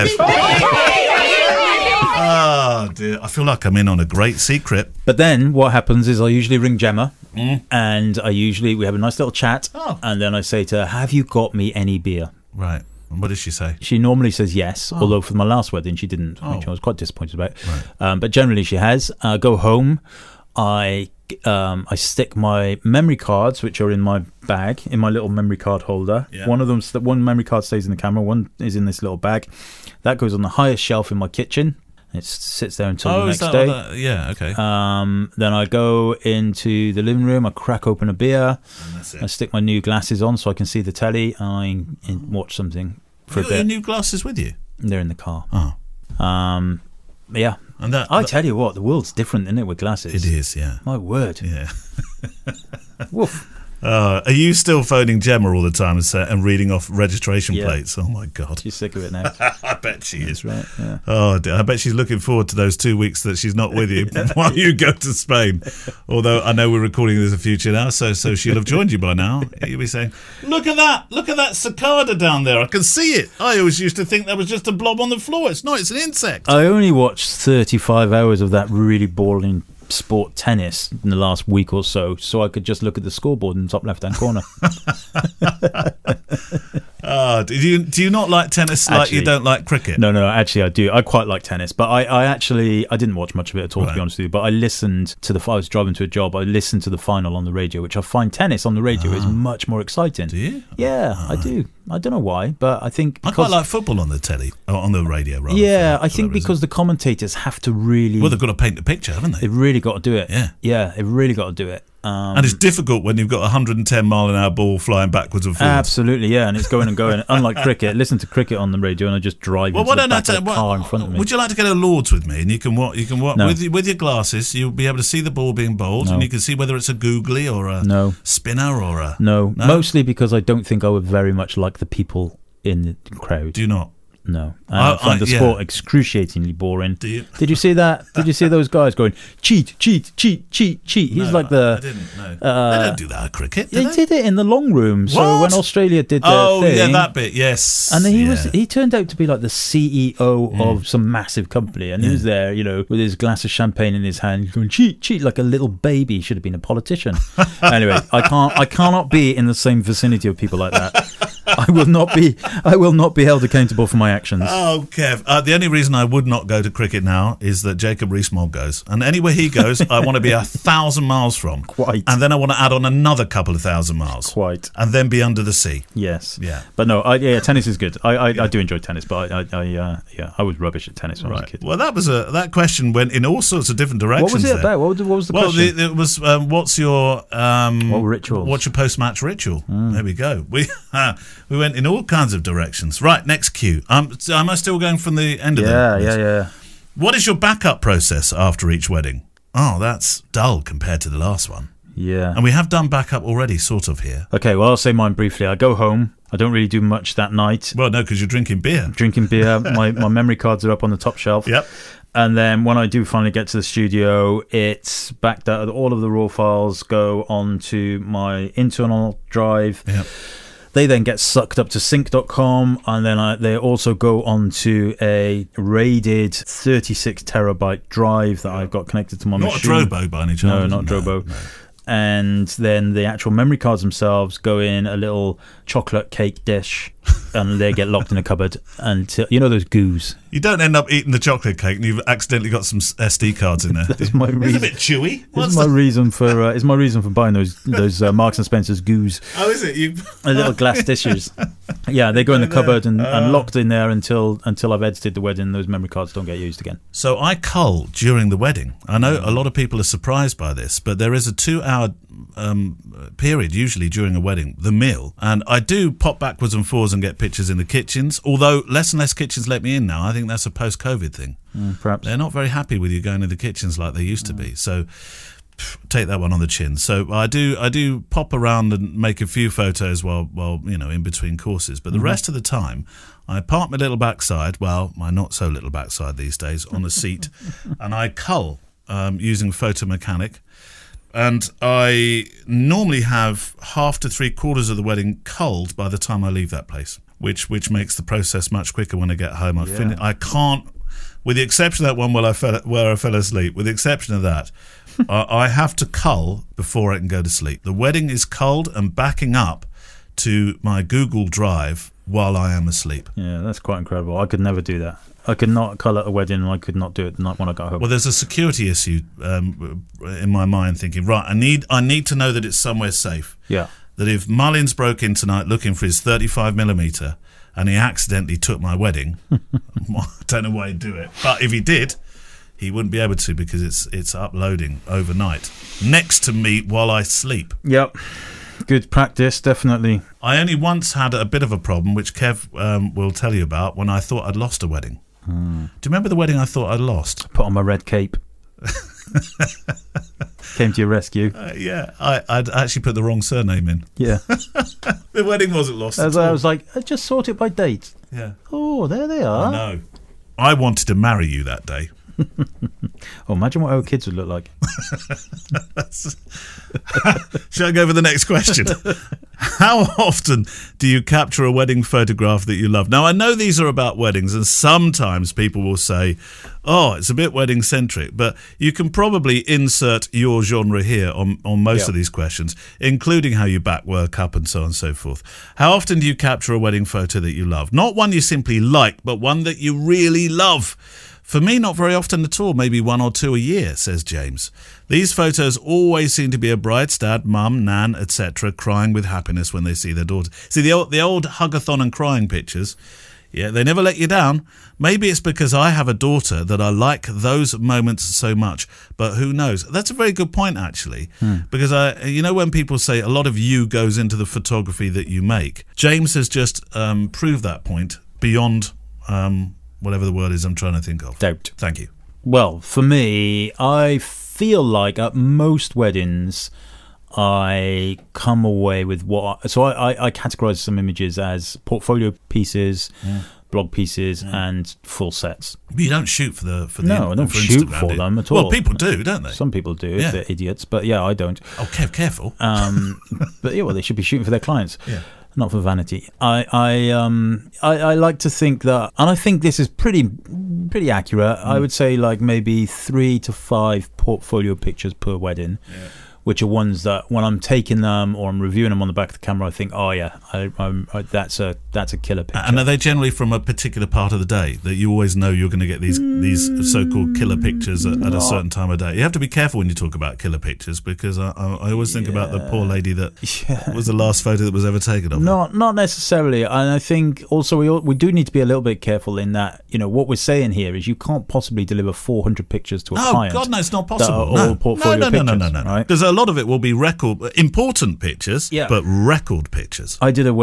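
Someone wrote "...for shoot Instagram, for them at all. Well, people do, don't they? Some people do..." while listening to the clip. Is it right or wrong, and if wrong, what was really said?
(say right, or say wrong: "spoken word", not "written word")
right.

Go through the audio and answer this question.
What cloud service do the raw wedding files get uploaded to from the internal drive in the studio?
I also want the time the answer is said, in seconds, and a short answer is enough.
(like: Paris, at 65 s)
sync.com, at 221 s.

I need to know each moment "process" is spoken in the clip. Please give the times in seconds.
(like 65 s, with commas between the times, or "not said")
197 s, 298 s.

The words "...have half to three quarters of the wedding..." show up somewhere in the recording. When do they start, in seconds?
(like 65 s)
293 s.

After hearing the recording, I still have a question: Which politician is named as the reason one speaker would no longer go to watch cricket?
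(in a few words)
Jacob Rees-Mogg.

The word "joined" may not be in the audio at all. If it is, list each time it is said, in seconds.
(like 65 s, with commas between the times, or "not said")
68 s.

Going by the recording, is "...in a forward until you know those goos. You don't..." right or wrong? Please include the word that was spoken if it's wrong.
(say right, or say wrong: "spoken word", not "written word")
wrong: "cupboard", not "forward".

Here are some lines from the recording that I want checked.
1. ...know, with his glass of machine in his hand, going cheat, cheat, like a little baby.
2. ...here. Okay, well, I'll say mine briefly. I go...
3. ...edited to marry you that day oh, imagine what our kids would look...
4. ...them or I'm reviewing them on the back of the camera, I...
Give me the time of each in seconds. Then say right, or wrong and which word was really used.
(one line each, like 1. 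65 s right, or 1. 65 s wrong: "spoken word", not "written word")
1. 152 s wrong: "champagne", not "machine"
2. 204 s right
3. 360 s wrong: "wanted", not "edited"
4. 457 s right.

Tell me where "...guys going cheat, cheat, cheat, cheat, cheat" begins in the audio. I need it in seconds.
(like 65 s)
138 s.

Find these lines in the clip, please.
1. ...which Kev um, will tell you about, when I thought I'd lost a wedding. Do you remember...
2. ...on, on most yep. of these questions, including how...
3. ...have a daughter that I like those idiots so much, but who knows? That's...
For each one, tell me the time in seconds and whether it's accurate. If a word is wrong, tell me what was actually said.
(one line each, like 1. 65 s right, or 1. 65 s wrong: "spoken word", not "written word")
1. 341 s right
2. 381 s right
3. 405 s wrong: "moments", not "idiots".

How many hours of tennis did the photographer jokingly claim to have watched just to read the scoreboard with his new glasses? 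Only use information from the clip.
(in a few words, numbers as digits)
35.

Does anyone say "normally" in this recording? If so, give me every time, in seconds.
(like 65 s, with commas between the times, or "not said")
13 s, 292 s.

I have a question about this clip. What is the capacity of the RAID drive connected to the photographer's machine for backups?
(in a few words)
36 terabytes.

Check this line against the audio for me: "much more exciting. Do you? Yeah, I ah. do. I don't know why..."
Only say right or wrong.
right.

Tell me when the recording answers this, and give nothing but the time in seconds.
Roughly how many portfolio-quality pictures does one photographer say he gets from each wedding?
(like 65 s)
452 s.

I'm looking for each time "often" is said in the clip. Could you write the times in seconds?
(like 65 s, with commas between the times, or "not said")
369 s, 385 s, 391 s.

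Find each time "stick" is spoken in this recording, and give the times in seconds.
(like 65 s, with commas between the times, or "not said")
21 s, 39 s.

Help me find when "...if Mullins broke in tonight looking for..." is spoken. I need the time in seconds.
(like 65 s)
324 s.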